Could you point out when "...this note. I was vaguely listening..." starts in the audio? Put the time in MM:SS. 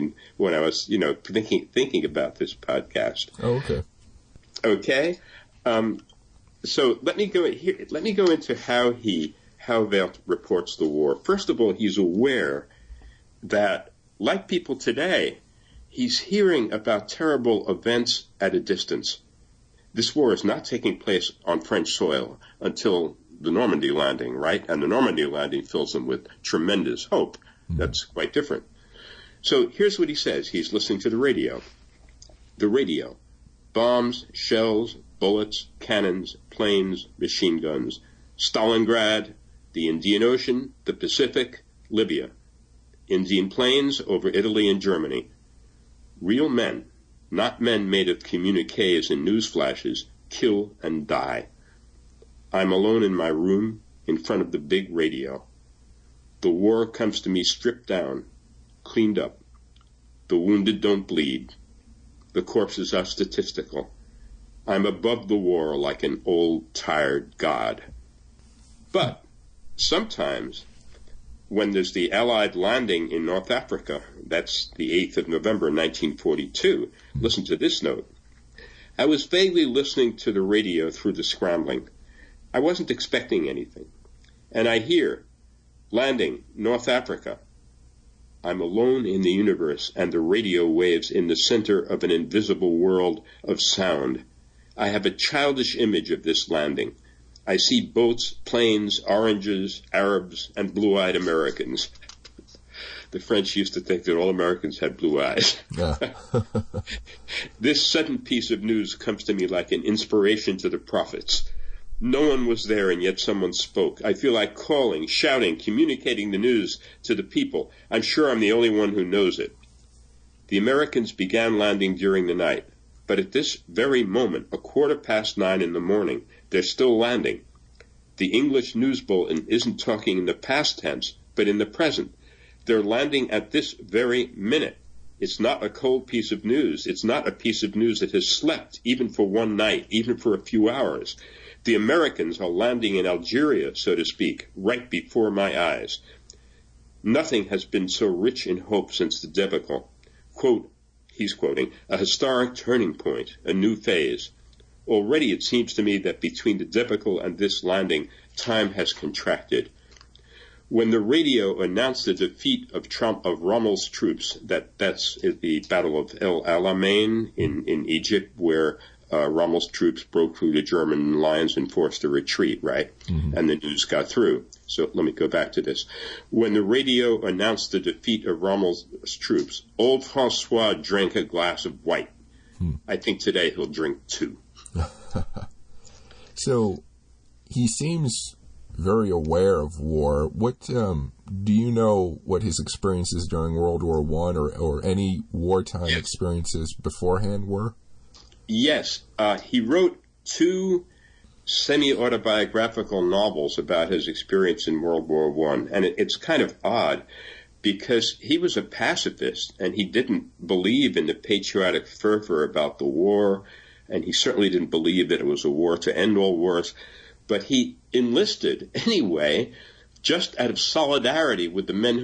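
01:17.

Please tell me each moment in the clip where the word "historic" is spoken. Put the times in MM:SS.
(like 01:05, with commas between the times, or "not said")
02:31.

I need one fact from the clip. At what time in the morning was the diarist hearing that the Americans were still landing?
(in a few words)
9:15.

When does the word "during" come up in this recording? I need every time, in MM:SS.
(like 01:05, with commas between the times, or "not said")
02:01, 03:13.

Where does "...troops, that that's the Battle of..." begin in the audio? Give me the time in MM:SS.
02:43.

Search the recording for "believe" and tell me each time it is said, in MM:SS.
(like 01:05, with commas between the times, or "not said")
03:30, 03:34.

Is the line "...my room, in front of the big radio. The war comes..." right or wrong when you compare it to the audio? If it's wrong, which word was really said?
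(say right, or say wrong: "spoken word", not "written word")
right.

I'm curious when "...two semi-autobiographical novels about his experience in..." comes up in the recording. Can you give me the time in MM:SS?
03:20.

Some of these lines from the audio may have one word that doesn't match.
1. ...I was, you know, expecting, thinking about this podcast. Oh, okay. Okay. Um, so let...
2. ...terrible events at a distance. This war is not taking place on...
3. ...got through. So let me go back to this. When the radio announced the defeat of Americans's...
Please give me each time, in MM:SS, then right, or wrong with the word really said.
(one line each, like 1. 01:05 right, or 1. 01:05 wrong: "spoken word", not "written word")
1. 00:00 wrong: "thinking", not "expecting"
2. 00:17 right
3. 02:53 wrong: "Rommel", not "Americans".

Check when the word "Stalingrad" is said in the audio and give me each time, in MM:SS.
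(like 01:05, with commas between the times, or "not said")
00:38.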